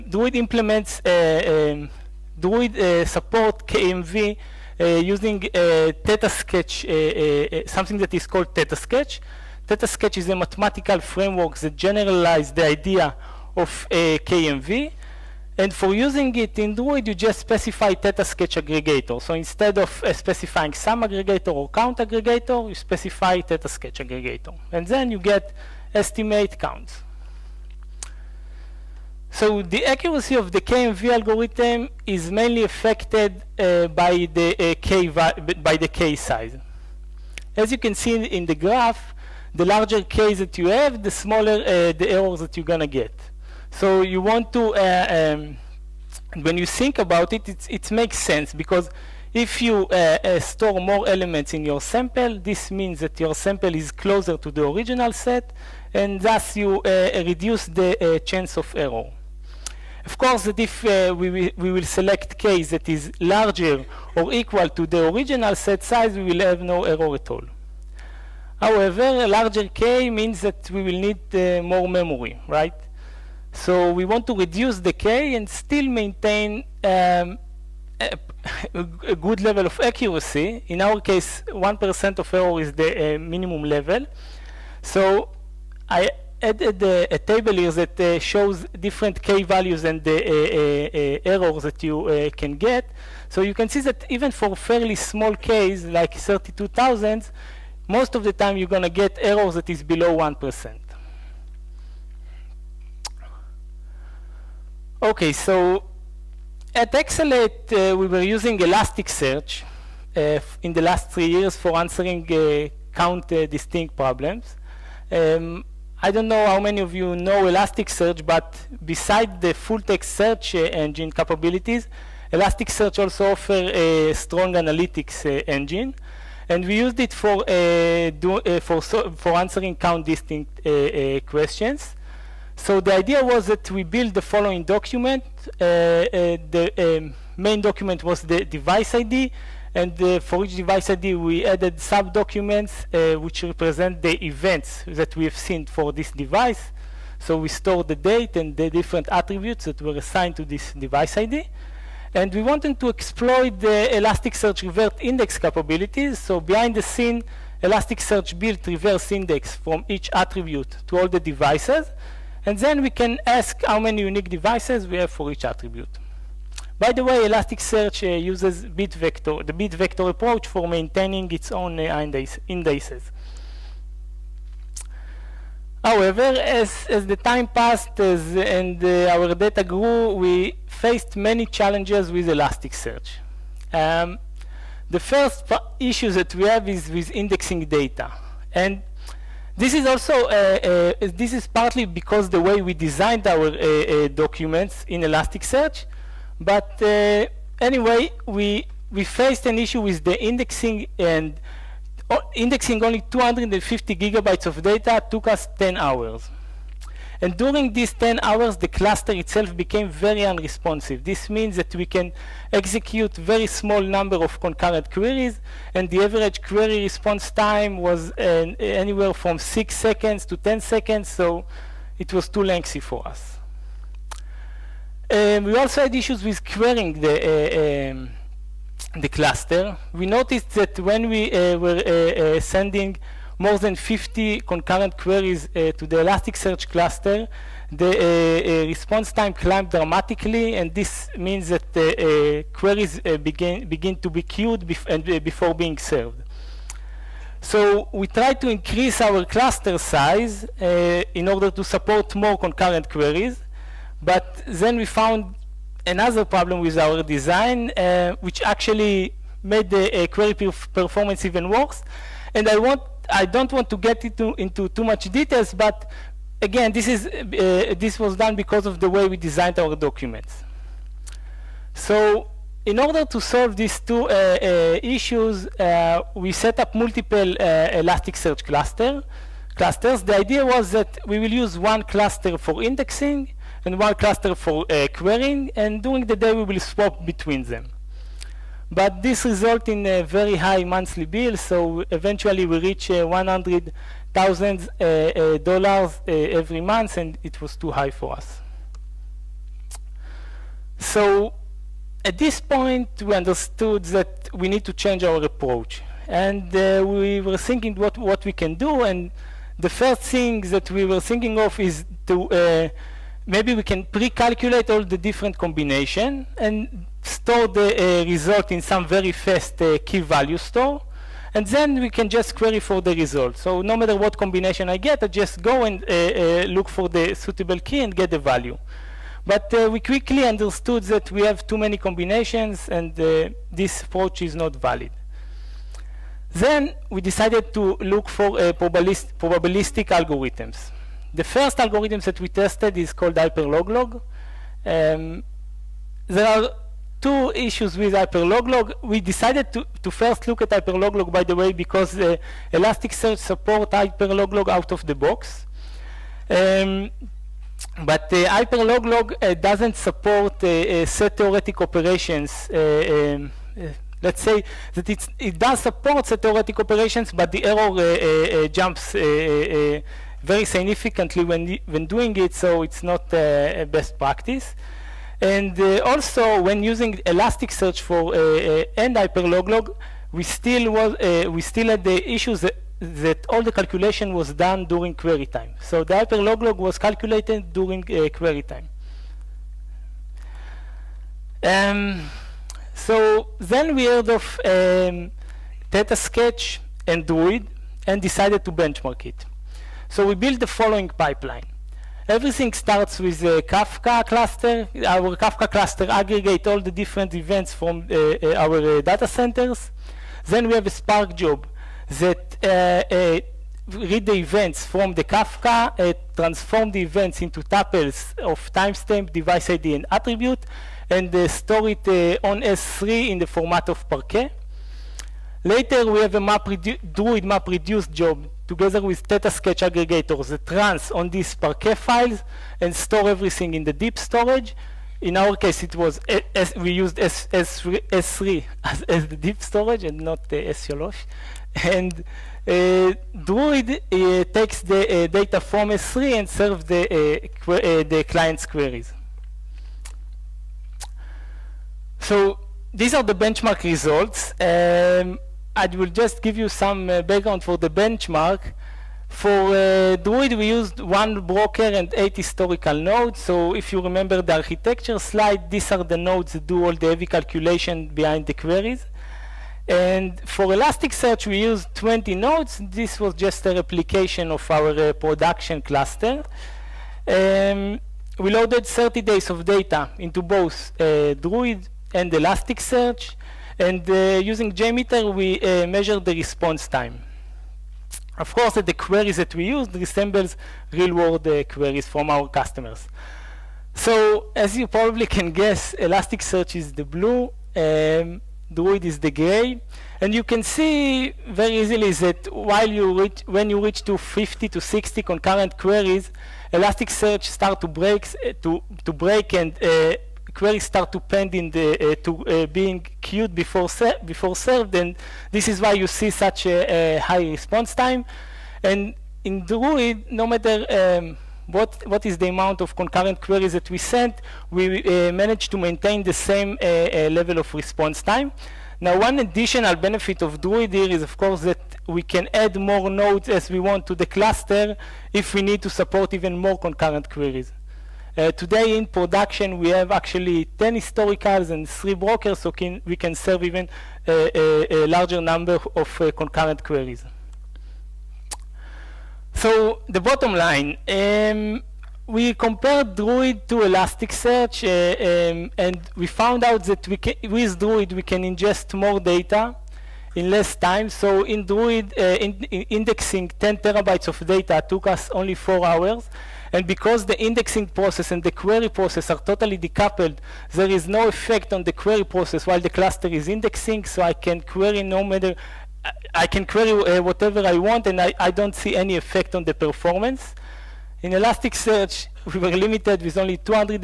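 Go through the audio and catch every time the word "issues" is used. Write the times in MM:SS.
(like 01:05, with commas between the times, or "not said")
03:05, 03:19, 03:45, 04:34, 05:47, 06:22.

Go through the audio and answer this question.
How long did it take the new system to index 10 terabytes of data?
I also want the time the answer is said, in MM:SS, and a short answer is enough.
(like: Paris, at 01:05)
4 hours, at 09:25.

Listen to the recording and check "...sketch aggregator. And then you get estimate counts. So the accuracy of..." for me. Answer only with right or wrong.
right.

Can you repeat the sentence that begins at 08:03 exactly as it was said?
And uh, using JMeter, we uh, measure the response time.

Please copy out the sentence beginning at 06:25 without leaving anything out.
So the Hyperloglog was calculated during uh, query time.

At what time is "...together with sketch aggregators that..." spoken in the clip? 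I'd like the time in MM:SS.
07:08.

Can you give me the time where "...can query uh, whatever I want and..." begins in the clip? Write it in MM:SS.
09:36.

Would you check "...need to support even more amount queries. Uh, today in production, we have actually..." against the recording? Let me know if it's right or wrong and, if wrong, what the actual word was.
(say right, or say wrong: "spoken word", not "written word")
wrong: "concurrent", not "amount".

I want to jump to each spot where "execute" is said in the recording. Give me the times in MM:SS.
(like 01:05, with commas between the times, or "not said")
03:32.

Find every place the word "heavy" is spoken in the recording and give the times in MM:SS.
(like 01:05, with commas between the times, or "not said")
07:46.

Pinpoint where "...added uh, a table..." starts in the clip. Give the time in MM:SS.
01:26.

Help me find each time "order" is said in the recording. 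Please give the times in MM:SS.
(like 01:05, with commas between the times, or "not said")
04:11, 04:32.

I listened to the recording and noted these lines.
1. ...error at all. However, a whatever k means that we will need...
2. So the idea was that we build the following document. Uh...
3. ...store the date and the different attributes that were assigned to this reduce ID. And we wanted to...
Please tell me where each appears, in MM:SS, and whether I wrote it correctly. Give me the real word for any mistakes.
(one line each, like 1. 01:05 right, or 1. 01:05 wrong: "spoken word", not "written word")
1. 01:06 wrong: "larger", not "whatever"
2. 02:12 right
3. 02:27 wrong: "device", not "reduce".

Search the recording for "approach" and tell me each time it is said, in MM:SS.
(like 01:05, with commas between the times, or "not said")
02:50, 05:05, 05:33.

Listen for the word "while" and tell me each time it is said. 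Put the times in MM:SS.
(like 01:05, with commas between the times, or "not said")
08:22, 09:32.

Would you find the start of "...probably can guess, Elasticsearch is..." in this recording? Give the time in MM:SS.
08:14.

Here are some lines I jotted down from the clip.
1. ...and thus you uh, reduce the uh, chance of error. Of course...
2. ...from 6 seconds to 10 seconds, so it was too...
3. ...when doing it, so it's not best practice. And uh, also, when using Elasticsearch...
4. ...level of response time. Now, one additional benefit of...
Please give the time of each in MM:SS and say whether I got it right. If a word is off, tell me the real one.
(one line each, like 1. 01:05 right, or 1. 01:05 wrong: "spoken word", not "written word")
1. 00:55 right
2. 03:39 right
3. 06:11 right
4. 08:47 right.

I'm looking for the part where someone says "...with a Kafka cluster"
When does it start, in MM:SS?
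06:42.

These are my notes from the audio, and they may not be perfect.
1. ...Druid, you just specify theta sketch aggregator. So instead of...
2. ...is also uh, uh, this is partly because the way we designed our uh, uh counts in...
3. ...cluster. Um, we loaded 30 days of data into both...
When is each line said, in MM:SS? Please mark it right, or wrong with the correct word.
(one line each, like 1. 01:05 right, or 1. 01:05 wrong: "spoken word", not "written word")
1. 00:16 right
2. 03:09 wrong: "documents", not "counts"
3. 07:55 right.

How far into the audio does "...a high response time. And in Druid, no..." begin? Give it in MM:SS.
08:36.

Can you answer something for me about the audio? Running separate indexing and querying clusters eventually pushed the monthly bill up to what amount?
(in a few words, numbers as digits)
$100,000.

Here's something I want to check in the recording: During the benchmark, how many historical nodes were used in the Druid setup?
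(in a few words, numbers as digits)
8.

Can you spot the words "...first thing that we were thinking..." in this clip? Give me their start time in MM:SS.
05:09.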